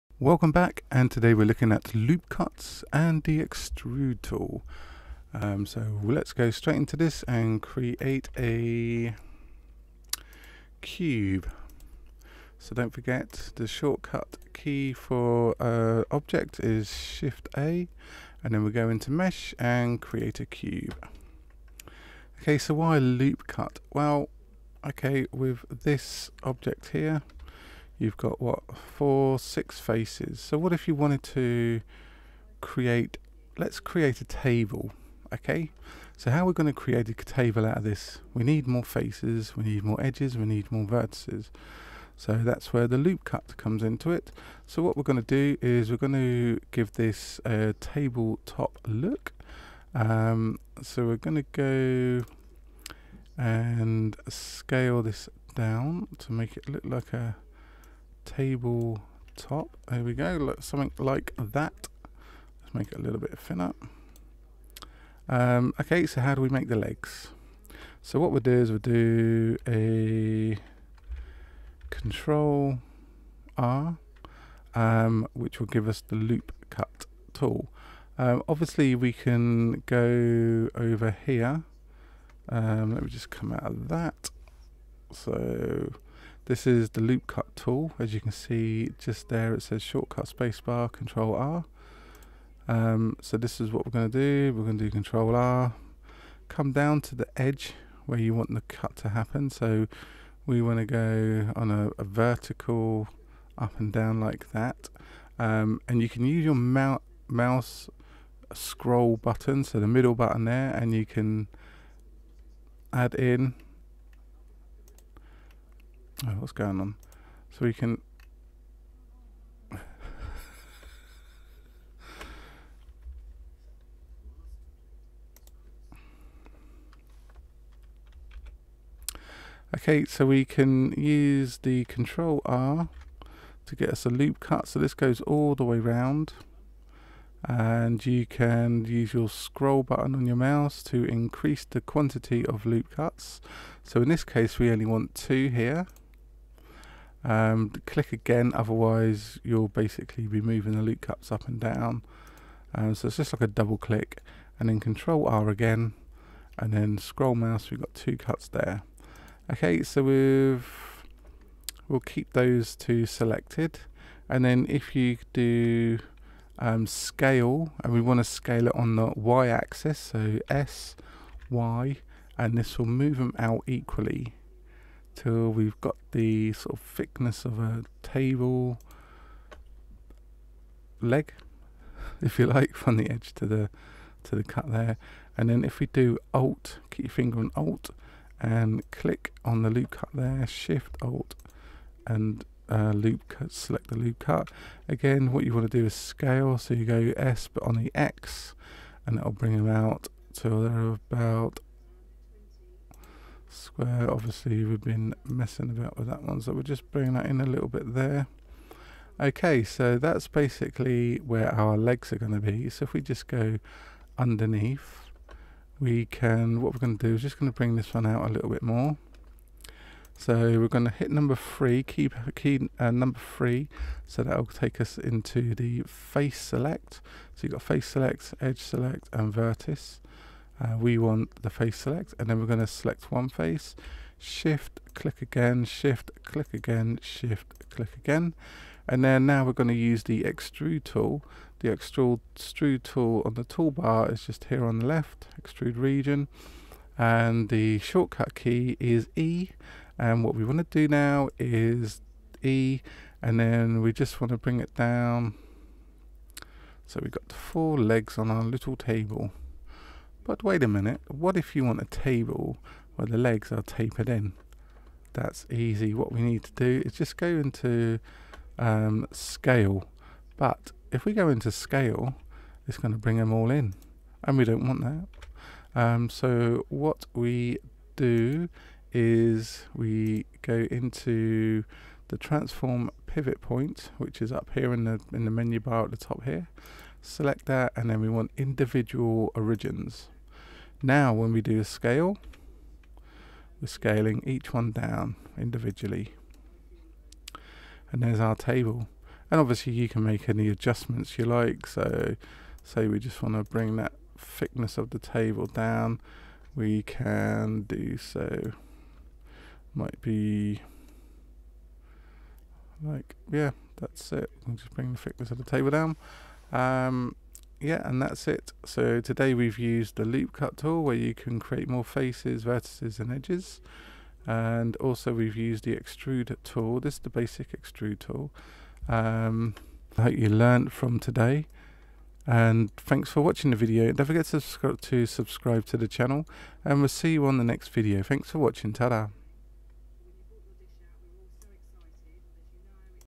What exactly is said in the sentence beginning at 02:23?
So in this case, we only want two here.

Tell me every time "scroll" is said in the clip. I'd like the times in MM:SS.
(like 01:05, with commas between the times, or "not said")
01:48, 02:19, 02:36.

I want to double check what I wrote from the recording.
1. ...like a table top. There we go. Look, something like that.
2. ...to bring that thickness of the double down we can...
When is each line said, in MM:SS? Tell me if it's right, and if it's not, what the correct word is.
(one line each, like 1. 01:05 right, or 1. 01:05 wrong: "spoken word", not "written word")
1. 00:56 right
2. 05:03 wrong: "table", not "double".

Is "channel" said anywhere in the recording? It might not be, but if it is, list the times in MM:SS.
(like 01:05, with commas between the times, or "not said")
05:35.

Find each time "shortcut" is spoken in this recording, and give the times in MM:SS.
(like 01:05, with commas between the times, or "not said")
00:13, 01:29, 04:07.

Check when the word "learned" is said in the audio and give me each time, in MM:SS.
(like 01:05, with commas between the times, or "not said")
05:30.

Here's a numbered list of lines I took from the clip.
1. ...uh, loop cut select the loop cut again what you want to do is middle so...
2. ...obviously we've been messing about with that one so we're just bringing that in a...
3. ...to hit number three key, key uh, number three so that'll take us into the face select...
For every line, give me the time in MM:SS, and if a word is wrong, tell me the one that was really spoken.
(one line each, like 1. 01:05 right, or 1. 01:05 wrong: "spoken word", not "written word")
1. 03:12 wrong: "scale", not "middle"
2. 03:24 right
3. 03:40 right.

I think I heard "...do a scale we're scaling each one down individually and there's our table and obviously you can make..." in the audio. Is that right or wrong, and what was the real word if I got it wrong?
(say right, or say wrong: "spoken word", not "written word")
right.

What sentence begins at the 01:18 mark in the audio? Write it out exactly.
Um, obviously, we can go over here.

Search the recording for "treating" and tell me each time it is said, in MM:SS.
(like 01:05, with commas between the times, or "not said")
not said.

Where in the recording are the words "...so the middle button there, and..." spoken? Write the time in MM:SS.
01:49.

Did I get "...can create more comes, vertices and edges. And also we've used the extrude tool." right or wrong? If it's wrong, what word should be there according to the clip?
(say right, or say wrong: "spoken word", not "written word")
wrong: "faces", not "comes".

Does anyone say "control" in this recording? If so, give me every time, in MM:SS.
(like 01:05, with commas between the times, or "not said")
01:11, 01:30, 01:34, 02:11, 02:34.